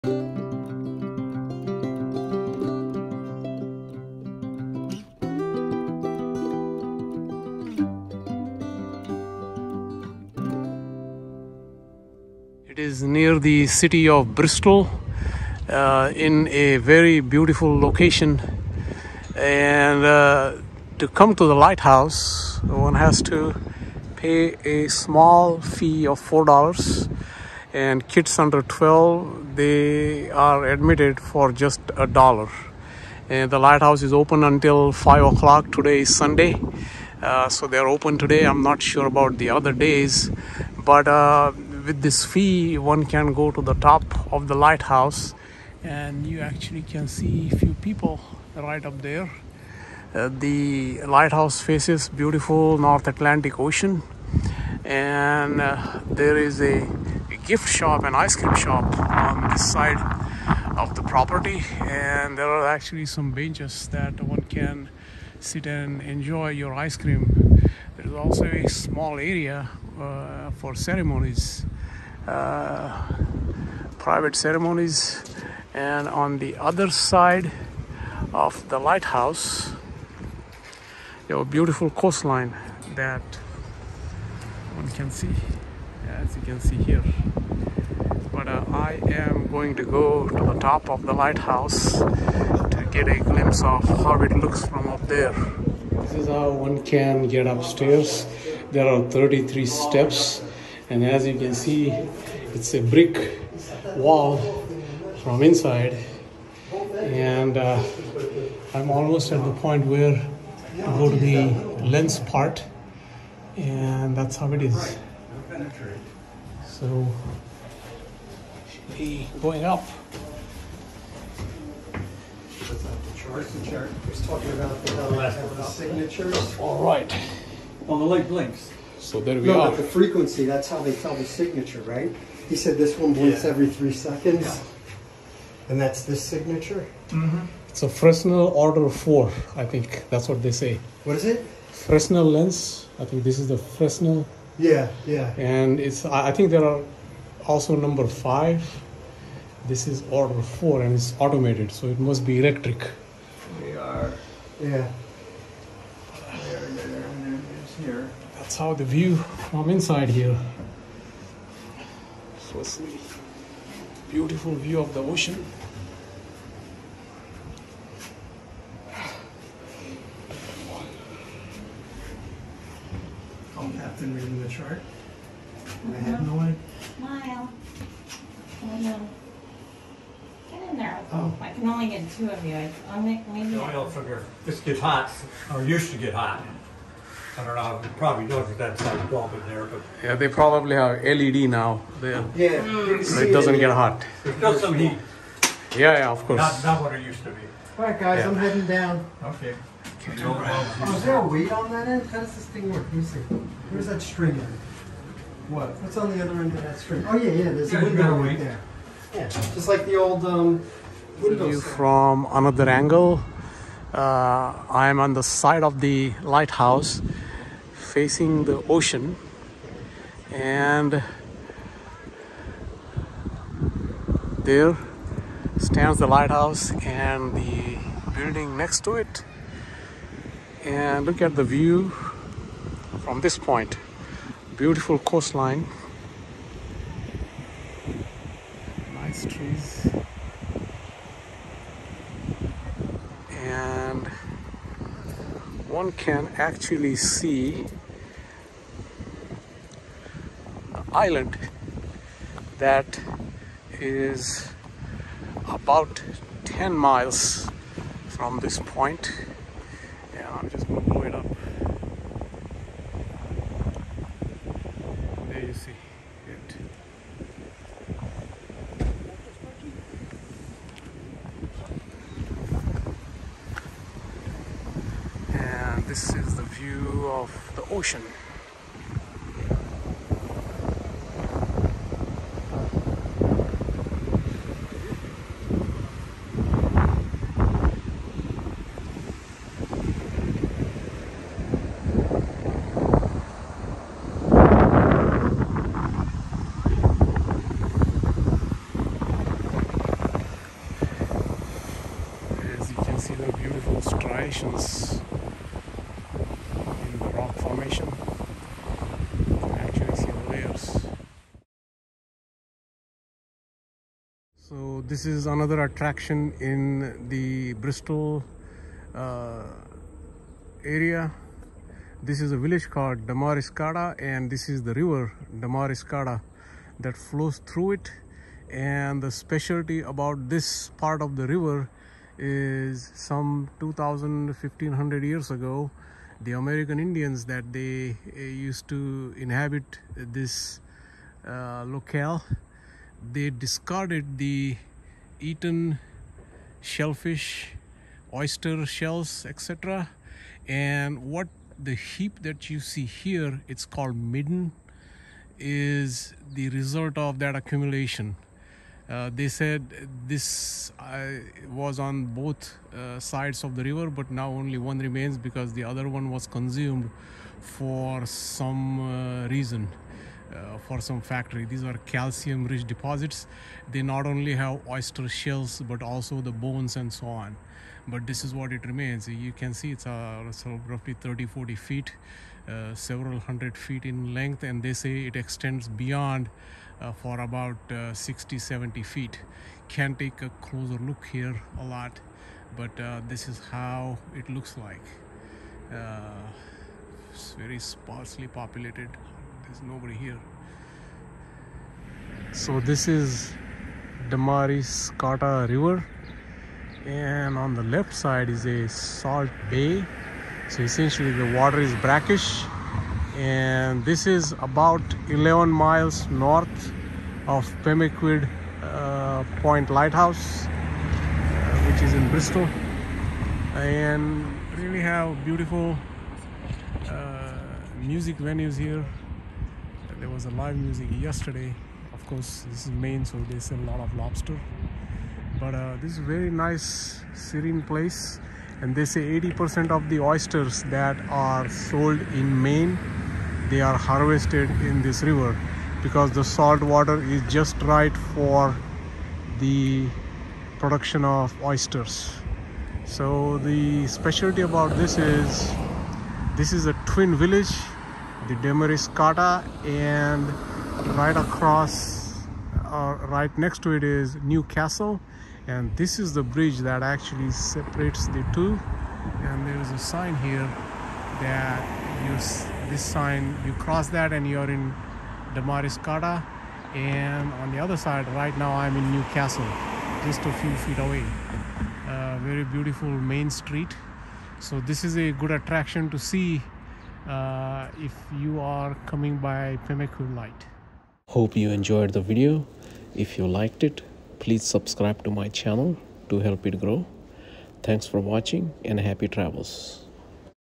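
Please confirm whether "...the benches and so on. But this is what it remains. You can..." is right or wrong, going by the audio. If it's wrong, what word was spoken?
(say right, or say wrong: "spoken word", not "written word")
wrong: "bones", not "benches".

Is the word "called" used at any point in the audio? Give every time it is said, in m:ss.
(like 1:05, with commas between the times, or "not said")
5:22, 5:53.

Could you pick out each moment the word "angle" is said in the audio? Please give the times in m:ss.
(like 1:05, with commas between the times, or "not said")
3:32.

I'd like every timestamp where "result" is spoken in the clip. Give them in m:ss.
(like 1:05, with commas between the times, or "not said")
5:56.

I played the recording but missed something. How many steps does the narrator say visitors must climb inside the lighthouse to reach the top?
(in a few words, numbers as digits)
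33.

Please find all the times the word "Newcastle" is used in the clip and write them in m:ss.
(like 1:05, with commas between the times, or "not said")
7:44, 7:58.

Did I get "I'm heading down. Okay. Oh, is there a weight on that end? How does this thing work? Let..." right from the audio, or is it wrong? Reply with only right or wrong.
right.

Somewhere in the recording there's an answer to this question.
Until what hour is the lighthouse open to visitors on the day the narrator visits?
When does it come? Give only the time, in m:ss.
0:34.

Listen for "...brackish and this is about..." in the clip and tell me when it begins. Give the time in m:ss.
6:51.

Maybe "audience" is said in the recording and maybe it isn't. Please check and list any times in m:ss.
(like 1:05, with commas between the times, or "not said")
not said.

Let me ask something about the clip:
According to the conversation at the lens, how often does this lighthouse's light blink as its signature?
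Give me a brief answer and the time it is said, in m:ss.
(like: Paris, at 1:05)
every three seconds, at 2:13.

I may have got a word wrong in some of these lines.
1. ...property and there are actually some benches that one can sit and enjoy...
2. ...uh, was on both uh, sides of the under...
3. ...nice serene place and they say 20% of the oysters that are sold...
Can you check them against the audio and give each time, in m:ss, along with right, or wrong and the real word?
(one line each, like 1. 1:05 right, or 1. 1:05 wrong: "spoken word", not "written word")
1. 1:01 right
2. 6:00 wrong: "river", not "under"
3. 7:16 wrong: "80", not "20".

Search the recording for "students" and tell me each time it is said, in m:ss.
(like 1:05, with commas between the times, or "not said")
not said.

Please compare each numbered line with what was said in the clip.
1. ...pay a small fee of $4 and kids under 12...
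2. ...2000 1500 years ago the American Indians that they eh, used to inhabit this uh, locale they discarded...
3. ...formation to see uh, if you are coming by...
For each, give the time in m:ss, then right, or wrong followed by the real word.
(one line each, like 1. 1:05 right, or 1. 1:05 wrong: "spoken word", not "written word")
1. 0:24 right
2. 5:33 right
3. 8:05 wrong: "attraction", not "formation".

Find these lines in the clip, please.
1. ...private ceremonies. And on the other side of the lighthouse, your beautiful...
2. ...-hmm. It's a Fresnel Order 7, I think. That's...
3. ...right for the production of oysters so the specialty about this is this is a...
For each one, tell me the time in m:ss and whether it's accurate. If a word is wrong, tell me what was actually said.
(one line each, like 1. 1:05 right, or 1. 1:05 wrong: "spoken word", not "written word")
1. 1:13 right
2. 2:17 wrong: "4", not "7"
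3. 7:27 right.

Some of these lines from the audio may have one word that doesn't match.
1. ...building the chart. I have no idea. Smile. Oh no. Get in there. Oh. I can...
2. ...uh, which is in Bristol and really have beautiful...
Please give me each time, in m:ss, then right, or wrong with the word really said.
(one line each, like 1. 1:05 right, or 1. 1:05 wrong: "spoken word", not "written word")
1. 2:54 wrong: "reading", not "building"
2. 7:00 right.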